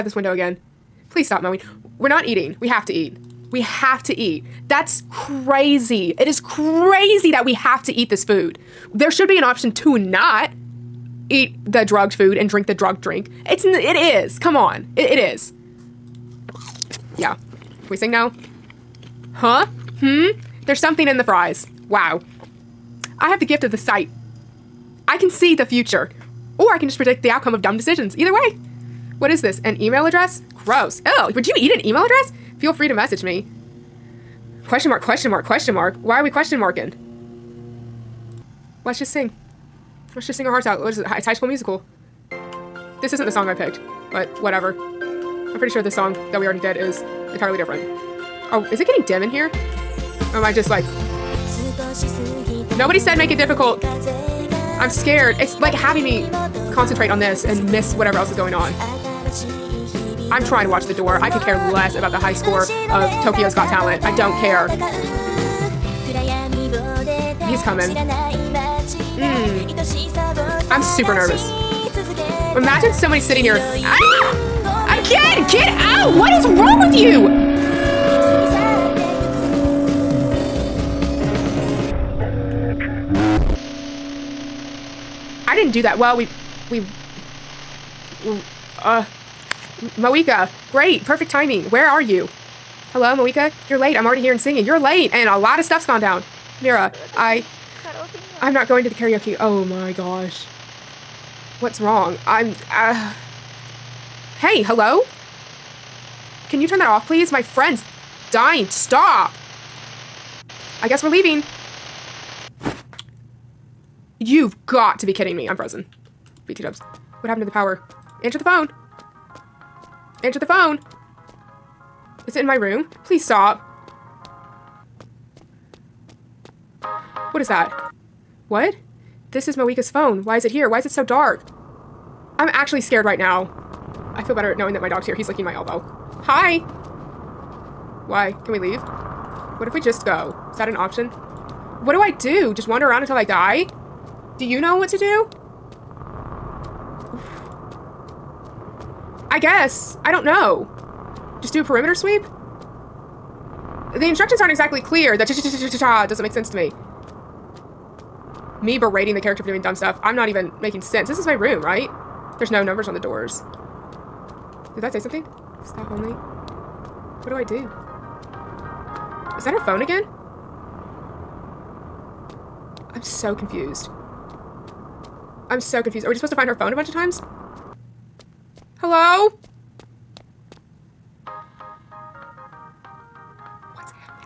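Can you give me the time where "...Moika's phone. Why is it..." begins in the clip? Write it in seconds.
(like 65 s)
129 s.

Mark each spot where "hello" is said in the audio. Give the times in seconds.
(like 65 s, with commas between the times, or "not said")
92 s, 104 s, 178 s.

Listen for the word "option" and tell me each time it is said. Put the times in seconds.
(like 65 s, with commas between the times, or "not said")
9 s, 140 s.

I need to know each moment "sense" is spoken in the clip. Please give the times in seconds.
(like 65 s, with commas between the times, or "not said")
156 s, 160 s.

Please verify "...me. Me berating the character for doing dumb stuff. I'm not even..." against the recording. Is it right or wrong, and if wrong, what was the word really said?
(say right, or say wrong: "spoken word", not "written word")
right.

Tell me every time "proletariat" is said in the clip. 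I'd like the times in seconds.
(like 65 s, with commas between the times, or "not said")
not said.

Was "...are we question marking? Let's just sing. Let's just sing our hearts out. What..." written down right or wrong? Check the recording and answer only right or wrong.
right.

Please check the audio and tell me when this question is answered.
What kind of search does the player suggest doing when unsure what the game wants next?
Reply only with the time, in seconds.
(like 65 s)
151 s.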